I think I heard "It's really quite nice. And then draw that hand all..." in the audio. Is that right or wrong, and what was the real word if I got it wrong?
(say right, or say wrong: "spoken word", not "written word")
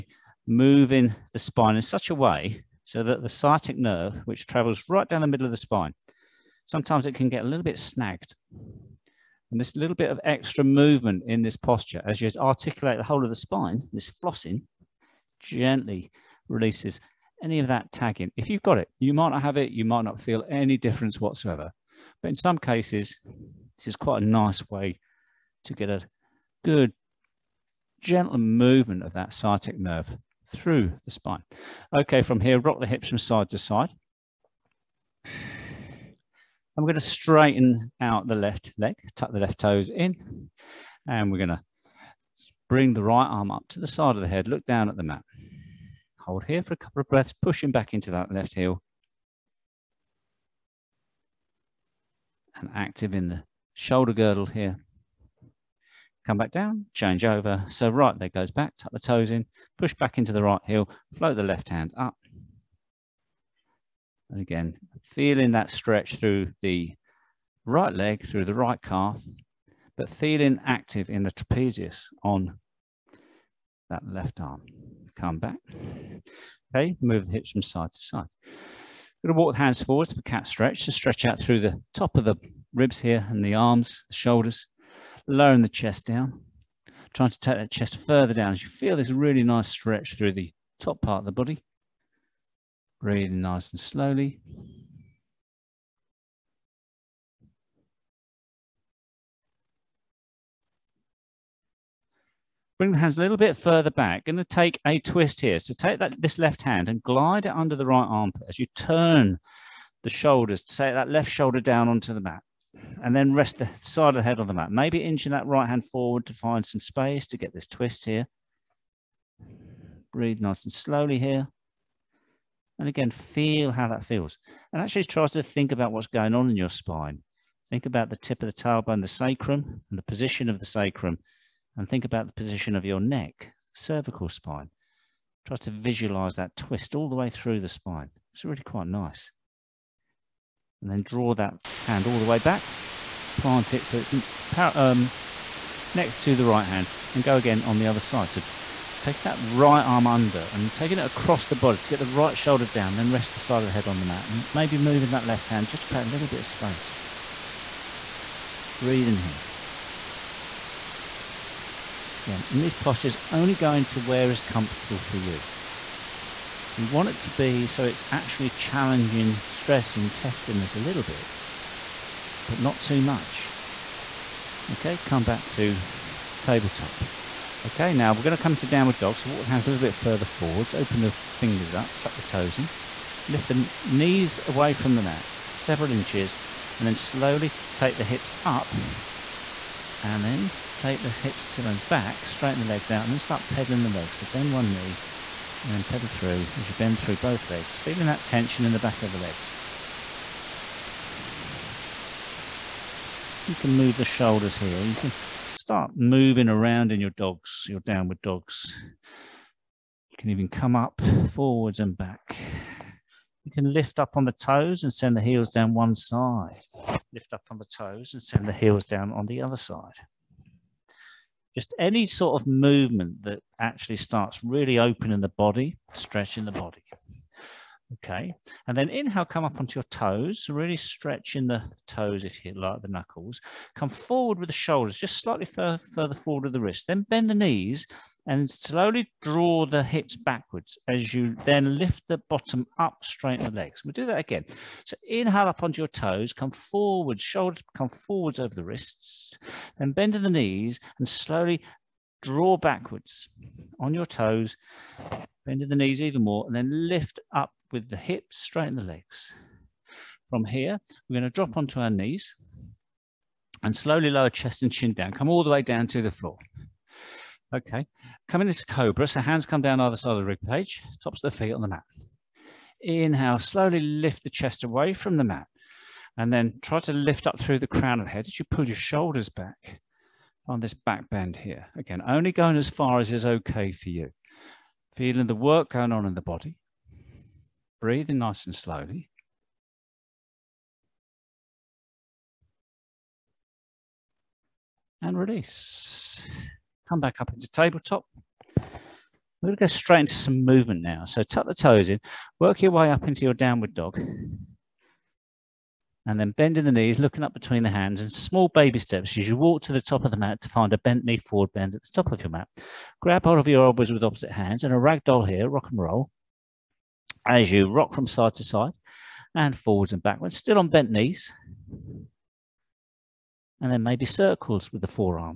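right.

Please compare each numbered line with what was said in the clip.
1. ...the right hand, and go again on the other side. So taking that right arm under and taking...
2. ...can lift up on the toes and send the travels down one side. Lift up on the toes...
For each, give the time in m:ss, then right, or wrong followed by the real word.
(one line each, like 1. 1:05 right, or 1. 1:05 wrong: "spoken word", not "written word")
1. 2:26 right
2. 3:33 wrong: "heels", not "travels".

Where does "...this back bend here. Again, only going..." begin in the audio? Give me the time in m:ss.
4:40.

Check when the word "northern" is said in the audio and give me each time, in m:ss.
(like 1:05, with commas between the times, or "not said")
not said.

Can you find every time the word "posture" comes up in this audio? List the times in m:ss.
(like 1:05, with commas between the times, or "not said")
0:11, 2:42.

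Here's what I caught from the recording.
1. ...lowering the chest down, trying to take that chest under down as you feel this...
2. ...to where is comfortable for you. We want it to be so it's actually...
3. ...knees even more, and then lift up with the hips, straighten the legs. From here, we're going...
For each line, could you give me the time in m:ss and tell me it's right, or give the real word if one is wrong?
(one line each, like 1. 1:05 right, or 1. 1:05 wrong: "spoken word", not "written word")
1. 1:25 wrong: "further", not "under"
2. 2:43 right
3. 4:15 right.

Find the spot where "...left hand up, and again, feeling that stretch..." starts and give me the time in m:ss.
1:01.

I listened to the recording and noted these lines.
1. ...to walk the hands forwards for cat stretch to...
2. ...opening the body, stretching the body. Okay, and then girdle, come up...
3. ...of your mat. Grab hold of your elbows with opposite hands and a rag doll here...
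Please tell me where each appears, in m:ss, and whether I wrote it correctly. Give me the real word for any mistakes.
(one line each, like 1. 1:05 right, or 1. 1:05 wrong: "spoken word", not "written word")
1. 1:19 right
2. 3:44 wrong: "inhale", not "girdle"
3. 5:12 right.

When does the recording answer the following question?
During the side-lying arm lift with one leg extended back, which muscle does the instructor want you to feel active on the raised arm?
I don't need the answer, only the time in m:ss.
1:11.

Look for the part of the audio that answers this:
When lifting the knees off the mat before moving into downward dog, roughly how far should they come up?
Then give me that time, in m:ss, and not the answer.
3:05.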